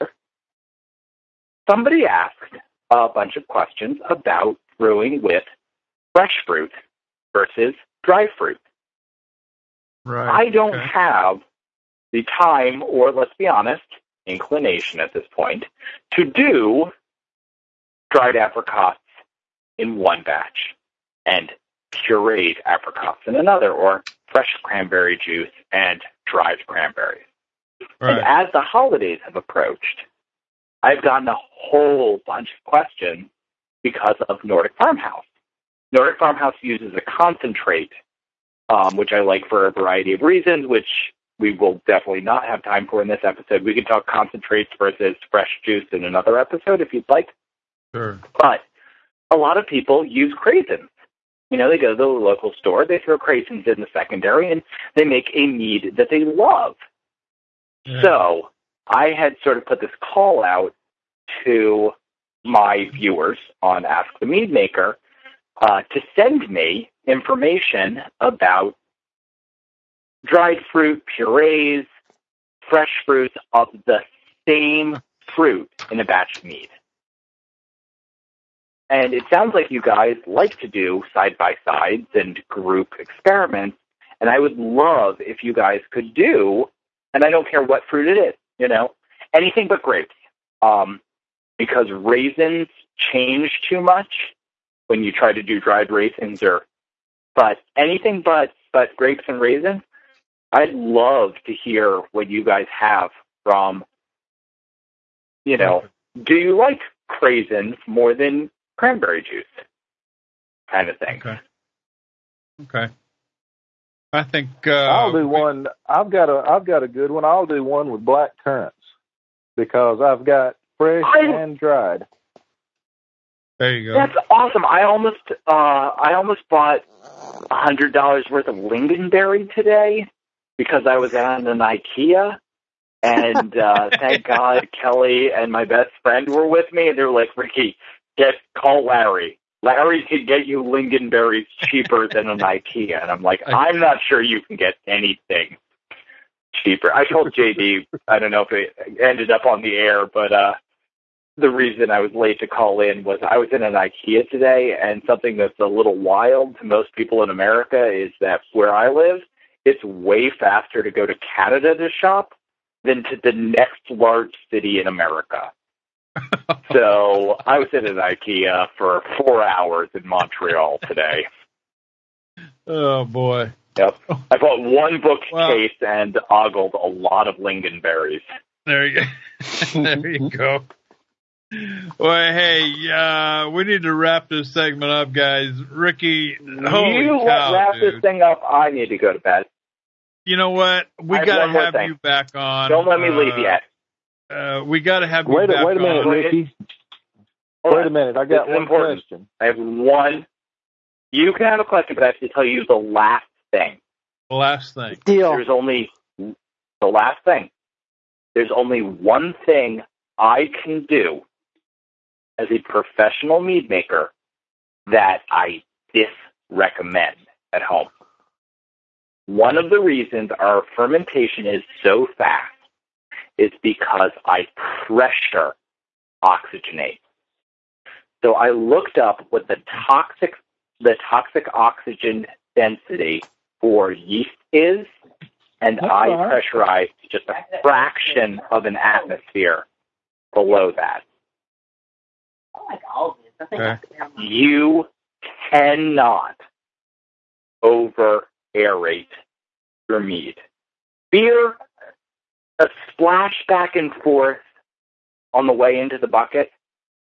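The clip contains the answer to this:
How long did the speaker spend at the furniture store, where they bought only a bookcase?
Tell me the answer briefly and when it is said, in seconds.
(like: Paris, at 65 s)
4 hours, at 169 s.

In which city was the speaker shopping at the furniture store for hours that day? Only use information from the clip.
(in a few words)
Montreal.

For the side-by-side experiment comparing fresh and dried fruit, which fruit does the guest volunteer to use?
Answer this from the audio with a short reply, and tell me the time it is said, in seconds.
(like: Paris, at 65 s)
black currants, at 118 s.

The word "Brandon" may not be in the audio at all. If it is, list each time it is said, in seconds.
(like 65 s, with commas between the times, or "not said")
not said.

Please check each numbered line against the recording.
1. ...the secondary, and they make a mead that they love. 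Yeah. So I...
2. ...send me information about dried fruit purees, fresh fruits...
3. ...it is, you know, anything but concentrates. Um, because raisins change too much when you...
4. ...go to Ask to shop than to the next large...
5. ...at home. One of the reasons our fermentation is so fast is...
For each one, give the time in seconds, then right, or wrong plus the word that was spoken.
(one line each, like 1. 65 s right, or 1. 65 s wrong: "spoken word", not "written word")
1. 53 s right
2. 66 s right
3. 88 s wrong: "grapes", not "concentrates"
4. 160 s wrong: "Canada", not "Ask"
5. 217 s right.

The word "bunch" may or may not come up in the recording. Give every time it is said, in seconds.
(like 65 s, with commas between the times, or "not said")
3 s, 32 s.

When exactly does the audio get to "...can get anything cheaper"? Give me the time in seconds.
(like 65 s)
144 s.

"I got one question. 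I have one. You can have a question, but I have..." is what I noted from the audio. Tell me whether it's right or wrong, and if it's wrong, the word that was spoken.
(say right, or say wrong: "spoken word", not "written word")
right.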